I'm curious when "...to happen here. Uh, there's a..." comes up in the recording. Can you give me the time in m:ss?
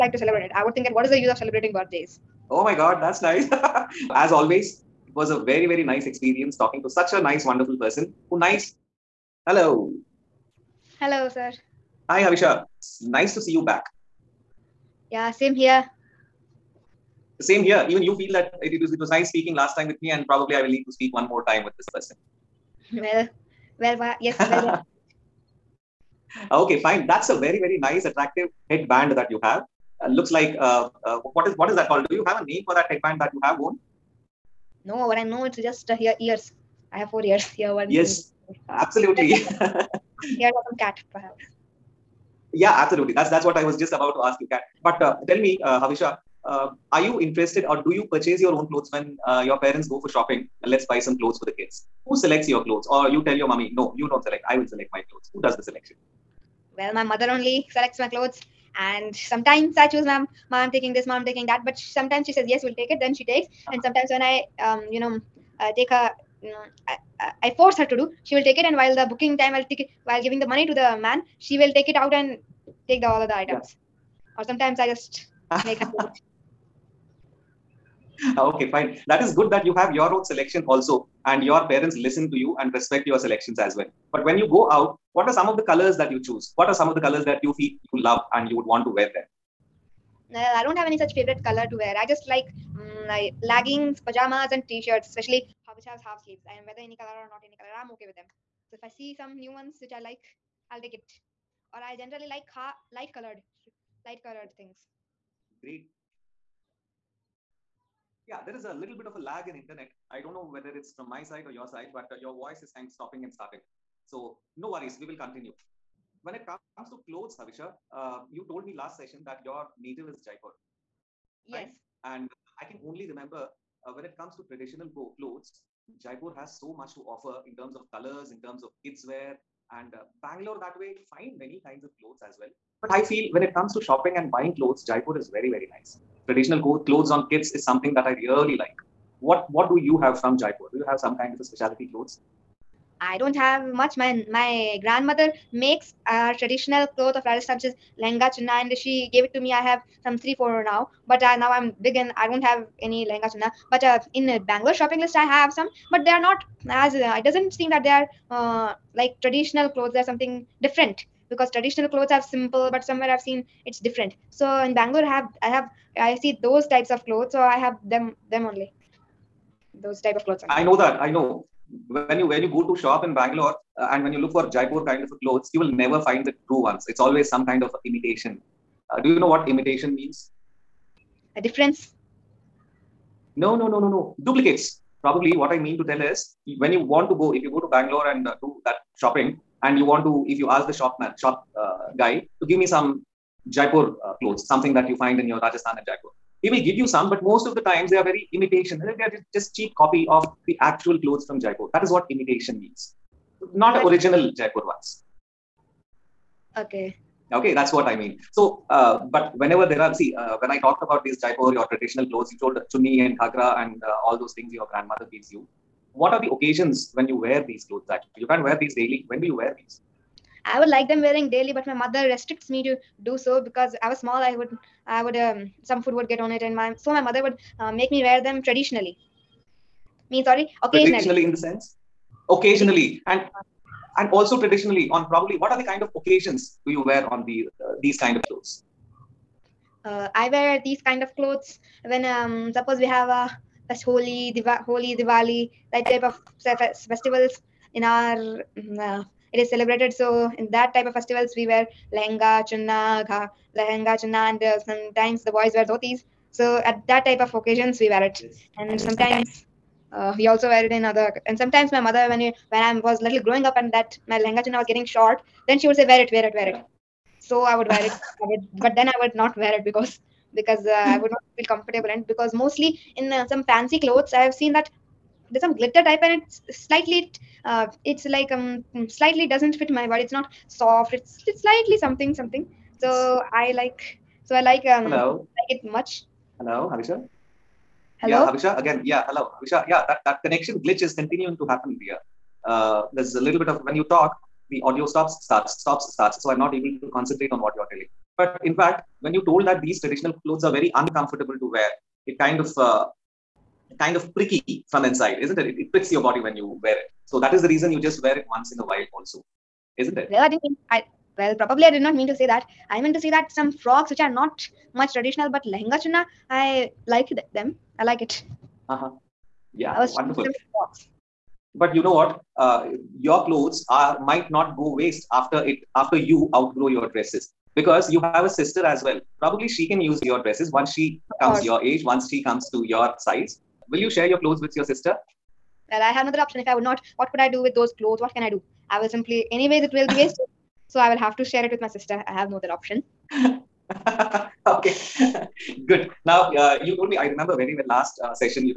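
4:51.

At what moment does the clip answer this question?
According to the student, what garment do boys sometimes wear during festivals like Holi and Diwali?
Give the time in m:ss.
4:15.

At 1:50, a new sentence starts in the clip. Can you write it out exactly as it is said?
I don't know whether it's from my side or your side, but uh, your voice is kind of stopping and starting.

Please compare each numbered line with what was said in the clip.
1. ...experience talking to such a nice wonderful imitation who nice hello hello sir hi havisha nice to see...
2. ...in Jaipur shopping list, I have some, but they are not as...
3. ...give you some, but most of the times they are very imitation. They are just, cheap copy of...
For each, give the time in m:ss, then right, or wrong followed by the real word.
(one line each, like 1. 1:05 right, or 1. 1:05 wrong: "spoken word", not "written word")
1. 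0:06 wrong: "person", not "imitation"
2. 2:34 wrong: "Bangalore", not "Jaipur"
3. 3:16 right.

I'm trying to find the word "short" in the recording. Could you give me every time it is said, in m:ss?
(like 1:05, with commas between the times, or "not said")
4:24.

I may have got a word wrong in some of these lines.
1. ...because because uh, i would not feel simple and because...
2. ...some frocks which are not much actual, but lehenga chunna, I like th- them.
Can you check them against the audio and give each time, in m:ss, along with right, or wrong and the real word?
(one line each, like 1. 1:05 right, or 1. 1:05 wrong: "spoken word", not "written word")
1. 4:29 wrong: "comfortable", not "simple"
2. 5:13 wrong: "traditional", not "actual".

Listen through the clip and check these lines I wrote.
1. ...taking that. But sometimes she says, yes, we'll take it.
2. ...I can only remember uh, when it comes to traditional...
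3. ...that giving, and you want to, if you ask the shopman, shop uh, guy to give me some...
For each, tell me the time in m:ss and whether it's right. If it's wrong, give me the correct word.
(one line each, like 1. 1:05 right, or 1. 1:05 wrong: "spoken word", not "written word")
1. 1:01 right
2. 2:02 right
3. 3:08 wrong: "shopping", not "giving".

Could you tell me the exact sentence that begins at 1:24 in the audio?
But when you go out, what are some of the colors that you choose?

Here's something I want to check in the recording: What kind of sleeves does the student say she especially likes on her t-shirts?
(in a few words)
half sleeves.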